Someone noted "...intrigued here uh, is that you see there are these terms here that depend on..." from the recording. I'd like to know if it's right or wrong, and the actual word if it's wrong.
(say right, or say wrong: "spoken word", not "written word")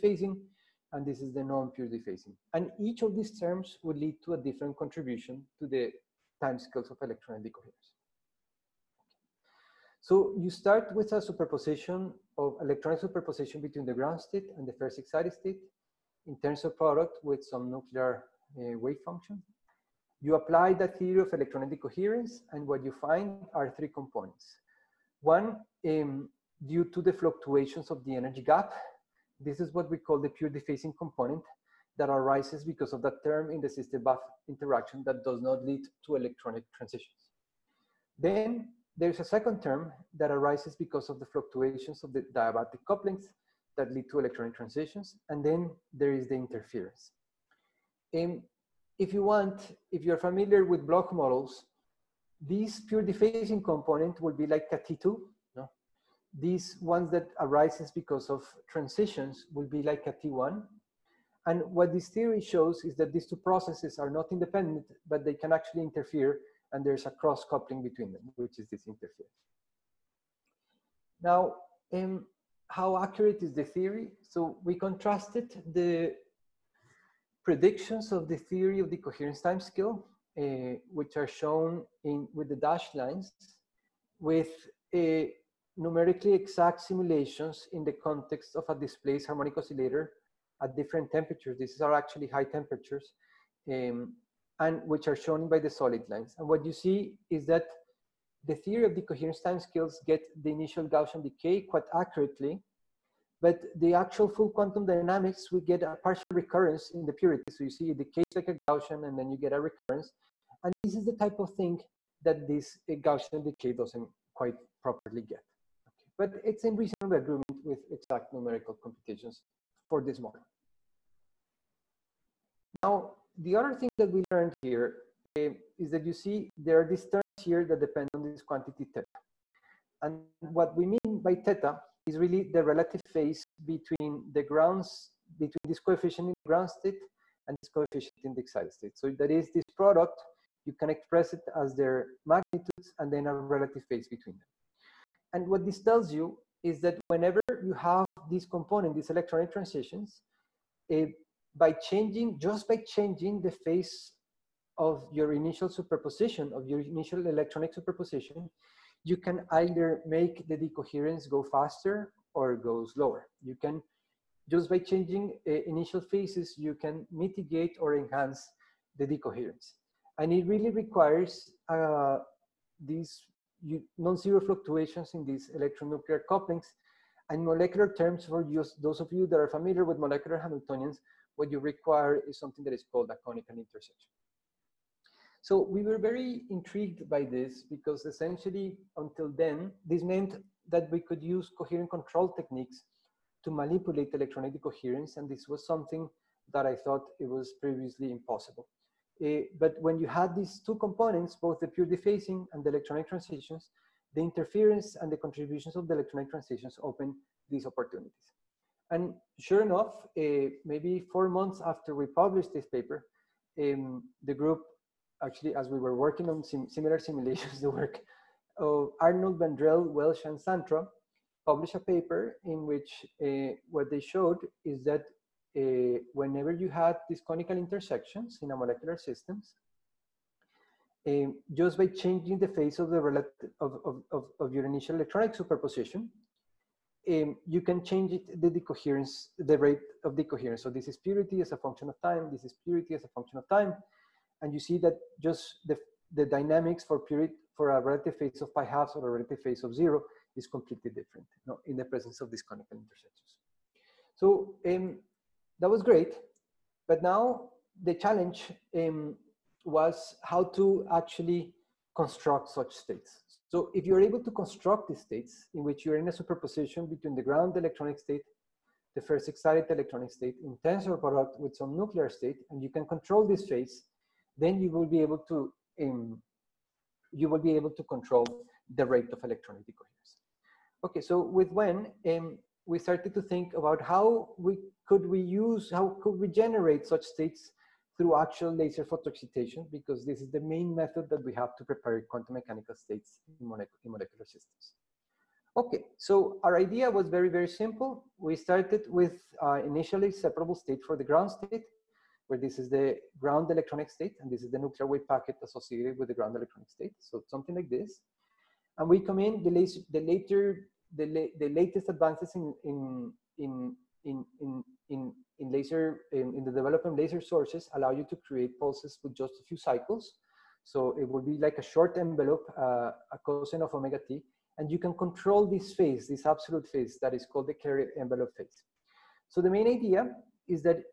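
wrong: "learned", not "intrigued".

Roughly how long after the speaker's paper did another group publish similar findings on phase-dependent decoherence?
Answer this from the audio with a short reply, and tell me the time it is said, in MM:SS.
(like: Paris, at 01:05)
4 months, at 03:31.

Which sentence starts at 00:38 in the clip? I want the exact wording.
Then there's a second term that arises because of the fluctuations of the diabatic couplings that lead to electronic transitions.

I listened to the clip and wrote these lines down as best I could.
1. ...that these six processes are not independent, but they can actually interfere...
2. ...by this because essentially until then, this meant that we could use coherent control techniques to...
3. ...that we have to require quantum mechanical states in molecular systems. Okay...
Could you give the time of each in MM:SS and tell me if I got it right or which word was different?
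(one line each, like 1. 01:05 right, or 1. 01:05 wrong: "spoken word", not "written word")
1. 01:02 wrong: "two", not "six"
2. 03:07 right
3. 04:51 wrong: "prepare", not "require".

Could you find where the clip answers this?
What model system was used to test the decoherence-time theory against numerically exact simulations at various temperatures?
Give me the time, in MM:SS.
01:28.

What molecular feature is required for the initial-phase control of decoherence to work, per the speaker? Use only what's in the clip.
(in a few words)
Conical intersection.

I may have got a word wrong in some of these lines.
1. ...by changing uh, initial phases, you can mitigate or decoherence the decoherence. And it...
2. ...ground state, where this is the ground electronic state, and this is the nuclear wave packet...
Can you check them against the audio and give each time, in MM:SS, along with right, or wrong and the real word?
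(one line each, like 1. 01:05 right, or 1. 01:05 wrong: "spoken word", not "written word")
1. 02:44 wrong: "enhance", not "decoherence"
2. 05:01 right.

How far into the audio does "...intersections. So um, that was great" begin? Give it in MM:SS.
04:12.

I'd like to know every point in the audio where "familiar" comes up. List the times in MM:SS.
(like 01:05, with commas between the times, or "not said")
00:50, 02:59.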